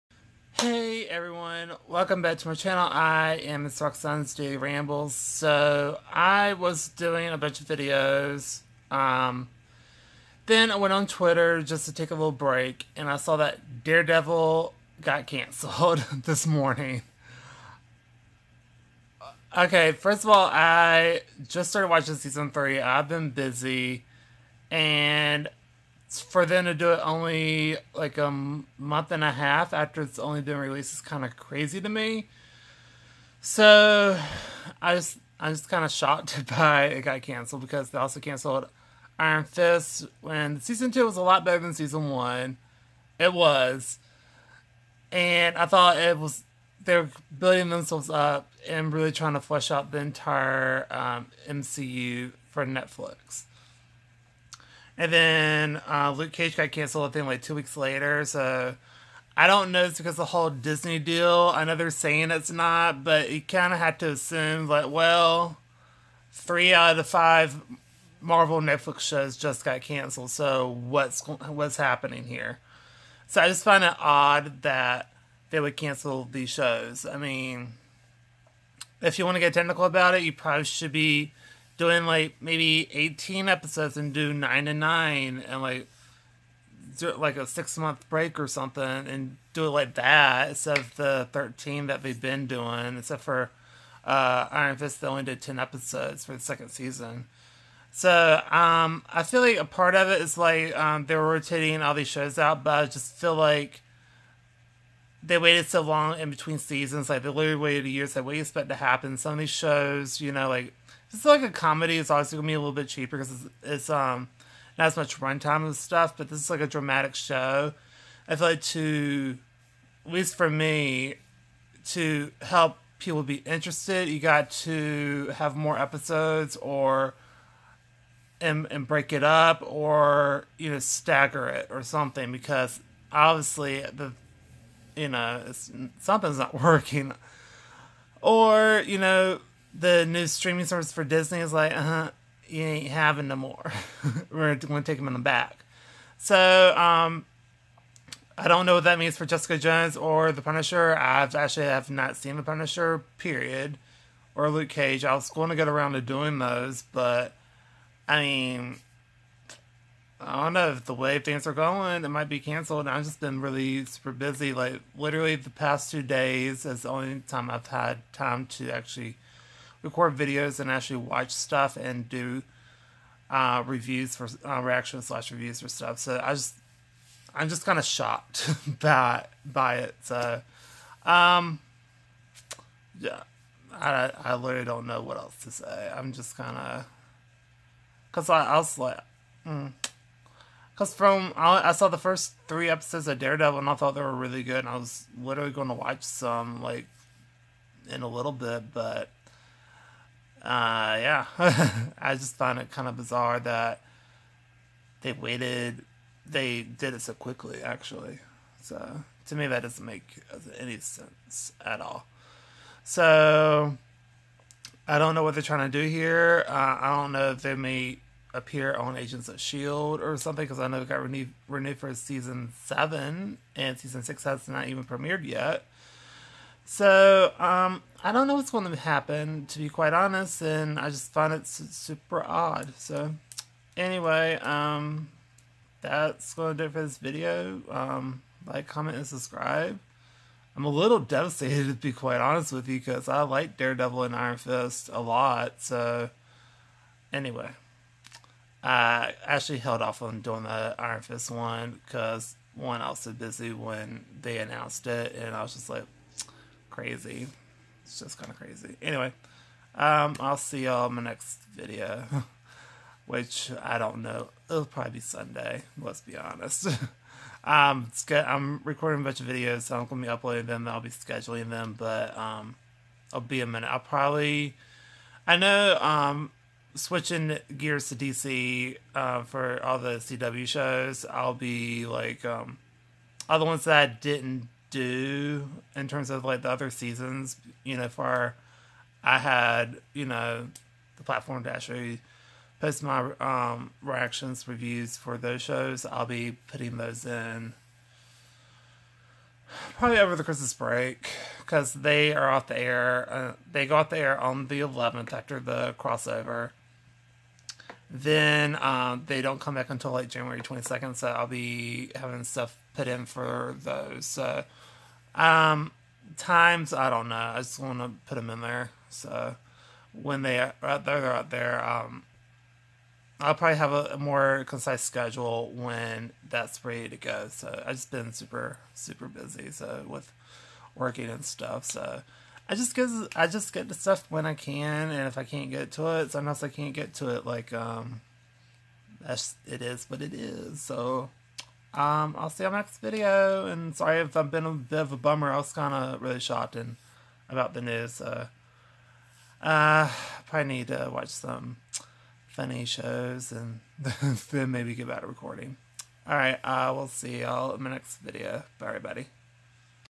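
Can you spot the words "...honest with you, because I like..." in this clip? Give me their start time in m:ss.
4:02.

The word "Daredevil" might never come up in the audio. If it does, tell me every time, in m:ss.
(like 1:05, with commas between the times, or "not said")
0:13, 3:13, 4:03.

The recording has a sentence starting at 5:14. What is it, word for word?
So, um, times I don't know.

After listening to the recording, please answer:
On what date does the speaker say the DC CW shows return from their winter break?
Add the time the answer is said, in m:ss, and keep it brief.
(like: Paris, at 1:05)
January 22nd, at 5:10.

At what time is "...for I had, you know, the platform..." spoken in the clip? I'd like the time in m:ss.
4:47.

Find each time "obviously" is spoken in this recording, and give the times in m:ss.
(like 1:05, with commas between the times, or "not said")
1:52, 2:13.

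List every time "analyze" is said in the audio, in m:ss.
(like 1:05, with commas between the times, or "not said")
not said.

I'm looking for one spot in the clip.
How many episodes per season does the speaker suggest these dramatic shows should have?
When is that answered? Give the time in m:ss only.
1:22.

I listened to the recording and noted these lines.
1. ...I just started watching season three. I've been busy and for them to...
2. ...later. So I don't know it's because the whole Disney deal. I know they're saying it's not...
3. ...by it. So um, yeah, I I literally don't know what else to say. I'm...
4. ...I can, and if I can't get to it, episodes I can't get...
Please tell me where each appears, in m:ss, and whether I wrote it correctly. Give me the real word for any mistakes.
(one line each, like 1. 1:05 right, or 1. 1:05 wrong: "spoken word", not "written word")
1. 0:20 right
2. 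0:57 right
3. 2:59 right
4. 5:34 wrong: "sometimes", not "episodes".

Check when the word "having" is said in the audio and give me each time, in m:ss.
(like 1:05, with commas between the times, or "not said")
2:22, 5:11.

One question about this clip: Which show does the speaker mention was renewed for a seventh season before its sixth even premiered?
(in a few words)
Agents of Shield.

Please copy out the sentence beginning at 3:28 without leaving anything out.
So to me, that doesn't make any sense at all.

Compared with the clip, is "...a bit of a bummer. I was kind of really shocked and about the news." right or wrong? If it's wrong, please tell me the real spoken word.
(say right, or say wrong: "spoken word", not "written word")
right.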